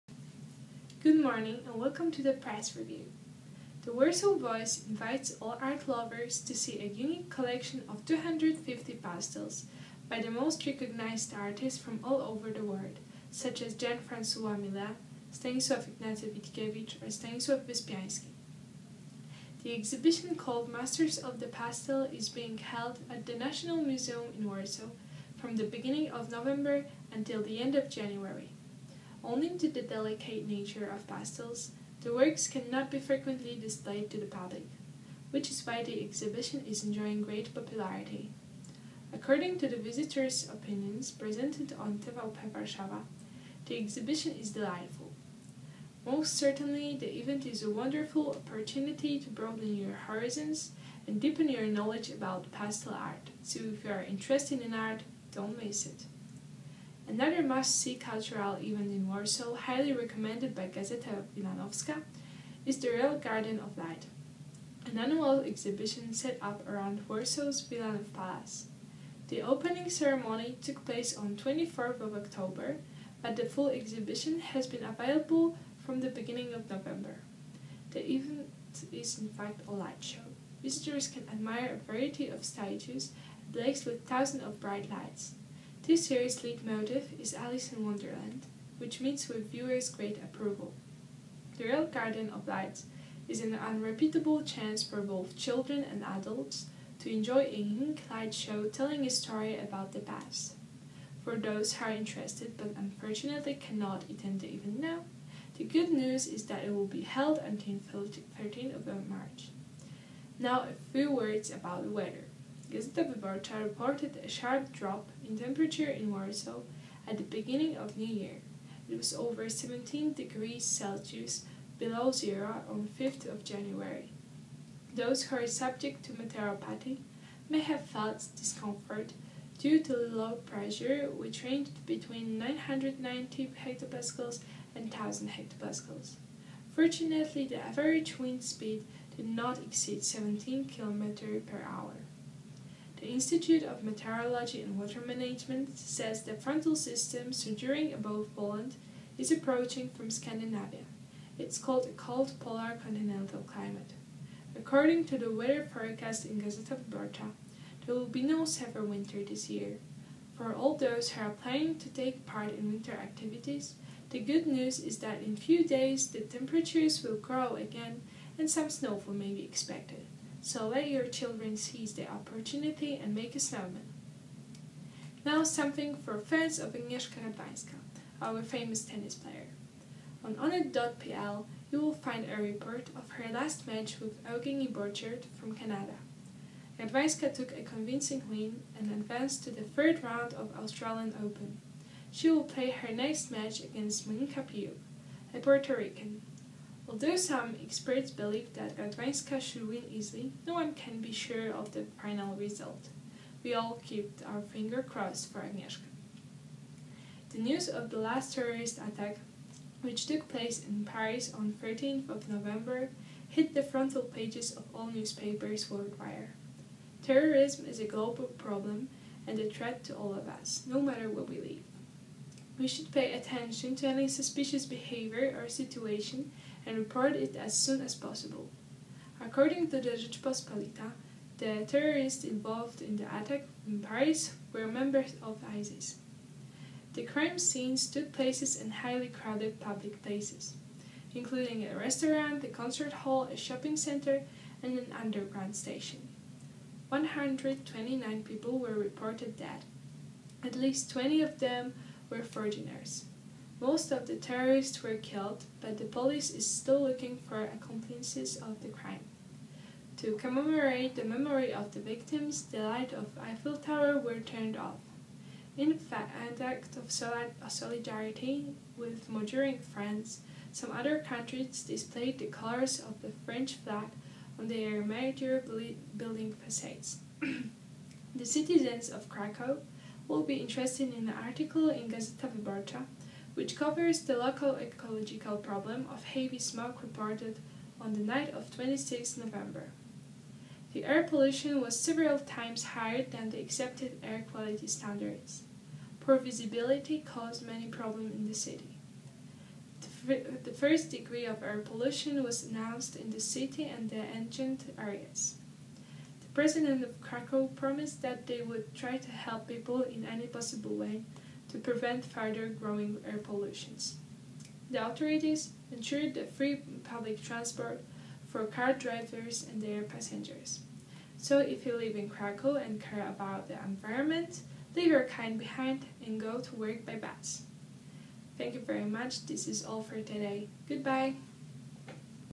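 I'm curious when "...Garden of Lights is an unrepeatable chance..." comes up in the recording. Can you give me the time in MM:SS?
01:31.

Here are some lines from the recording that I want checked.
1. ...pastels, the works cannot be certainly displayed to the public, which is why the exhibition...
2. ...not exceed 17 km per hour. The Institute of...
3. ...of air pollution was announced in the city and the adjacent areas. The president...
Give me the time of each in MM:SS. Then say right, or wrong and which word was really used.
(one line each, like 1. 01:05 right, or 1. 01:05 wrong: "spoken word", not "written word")
1. 00:31 wrong: "frequently", not "certainly"
2. 02:19 right
3. 05:01 right.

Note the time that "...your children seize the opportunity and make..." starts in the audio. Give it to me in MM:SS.
02:50.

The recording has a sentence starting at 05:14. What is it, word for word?
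The authorities ensured the free public transport for car drivers and their passengers.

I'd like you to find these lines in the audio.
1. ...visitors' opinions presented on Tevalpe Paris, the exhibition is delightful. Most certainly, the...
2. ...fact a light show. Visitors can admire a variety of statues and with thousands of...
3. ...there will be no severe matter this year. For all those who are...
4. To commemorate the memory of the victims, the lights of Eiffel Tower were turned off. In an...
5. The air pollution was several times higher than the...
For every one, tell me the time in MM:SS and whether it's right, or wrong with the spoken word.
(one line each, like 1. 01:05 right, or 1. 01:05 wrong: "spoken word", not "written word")
1. 00:39 wrong: "Warszawa", not "Paris"
2. 01:19 right
3. 02:37 wrong: "winter", not "matter"
4. 04:19 right
5. 04:50 right.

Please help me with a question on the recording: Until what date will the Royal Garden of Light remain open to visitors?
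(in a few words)
13 March.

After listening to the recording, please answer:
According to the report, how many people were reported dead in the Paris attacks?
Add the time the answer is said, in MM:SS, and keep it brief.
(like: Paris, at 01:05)
129, at 04:06.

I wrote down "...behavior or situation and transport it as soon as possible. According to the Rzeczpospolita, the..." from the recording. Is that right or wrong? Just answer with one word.
wrong.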